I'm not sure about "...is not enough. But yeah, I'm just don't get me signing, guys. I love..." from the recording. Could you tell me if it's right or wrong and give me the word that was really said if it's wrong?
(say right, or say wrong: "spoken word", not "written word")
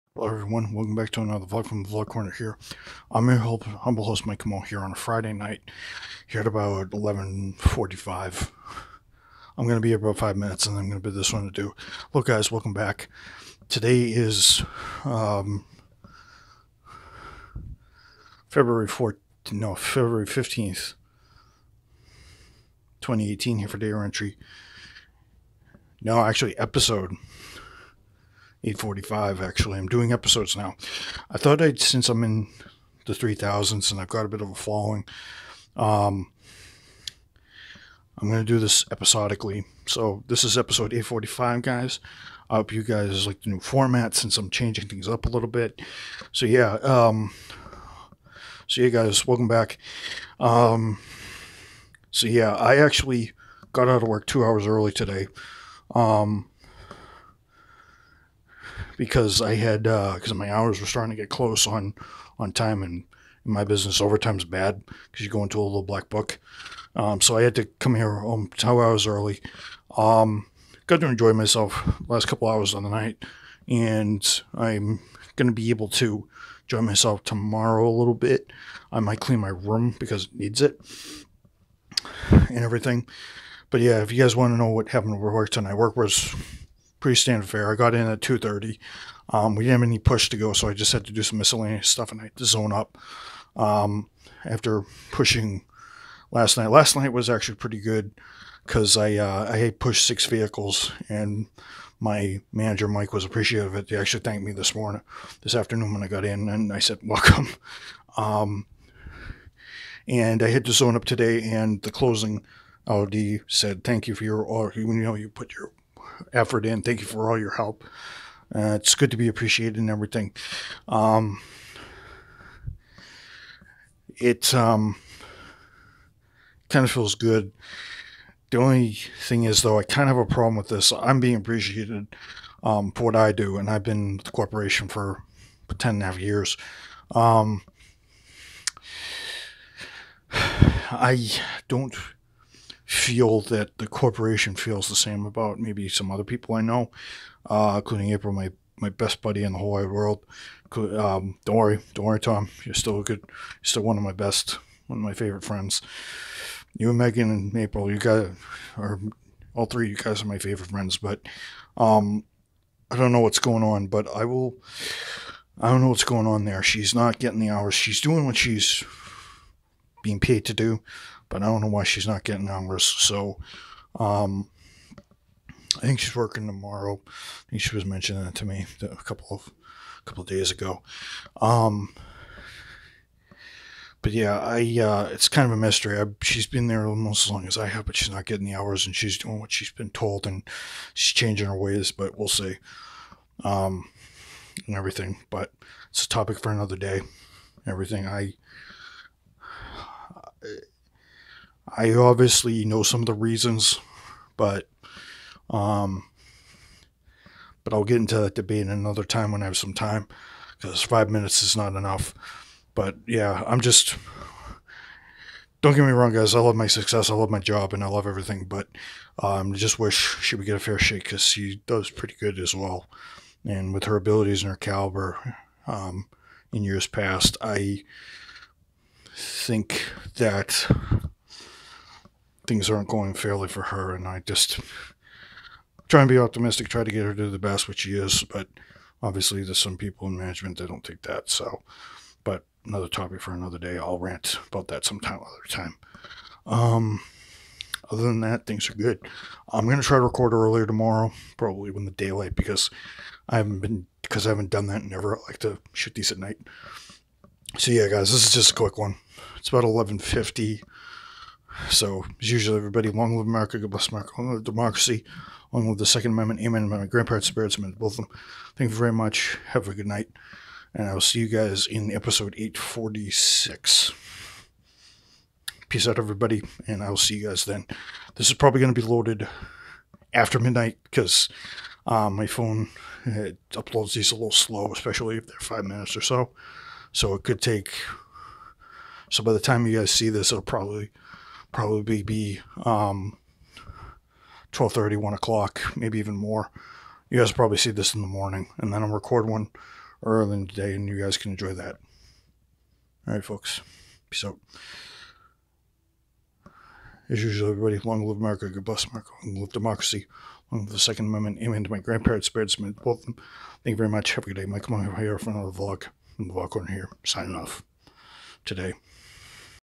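wrong: "wrong", not "signing".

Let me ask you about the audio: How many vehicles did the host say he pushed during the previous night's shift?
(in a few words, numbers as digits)
6.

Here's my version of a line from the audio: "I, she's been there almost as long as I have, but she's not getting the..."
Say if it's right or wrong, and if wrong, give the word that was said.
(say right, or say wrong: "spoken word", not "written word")
right.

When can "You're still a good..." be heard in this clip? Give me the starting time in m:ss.
2:32.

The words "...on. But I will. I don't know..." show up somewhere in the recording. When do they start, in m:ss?
2:43.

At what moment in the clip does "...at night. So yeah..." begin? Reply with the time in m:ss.
4:16.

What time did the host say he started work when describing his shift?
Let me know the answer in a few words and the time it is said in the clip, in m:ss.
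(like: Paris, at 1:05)
2:30, at 1:28.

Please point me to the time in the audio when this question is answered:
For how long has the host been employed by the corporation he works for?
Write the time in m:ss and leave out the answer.
2:15.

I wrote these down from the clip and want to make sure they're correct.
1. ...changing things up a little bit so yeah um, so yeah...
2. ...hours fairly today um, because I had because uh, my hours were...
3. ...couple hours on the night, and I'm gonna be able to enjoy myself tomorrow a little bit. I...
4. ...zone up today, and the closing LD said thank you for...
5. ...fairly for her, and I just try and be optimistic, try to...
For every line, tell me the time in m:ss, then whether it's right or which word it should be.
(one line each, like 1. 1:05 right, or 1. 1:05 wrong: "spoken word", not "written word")
1. 0:44 right
2. 0:54 wrong: "early", not "fairly"
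3. 1:12 right
4. 1:50 right
5. 3:53 right.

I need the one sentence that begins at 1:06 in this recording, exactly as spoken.
Um, so I had to come here home two hours early.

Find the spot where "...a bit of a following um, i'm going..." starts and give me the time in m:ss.
0:34.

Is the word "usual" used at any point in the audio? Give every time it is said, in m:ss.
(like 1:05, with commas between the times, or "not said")
4:22, 5:07.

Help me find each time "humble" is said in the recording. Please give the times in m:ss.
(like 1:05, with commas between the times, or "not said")
0:03.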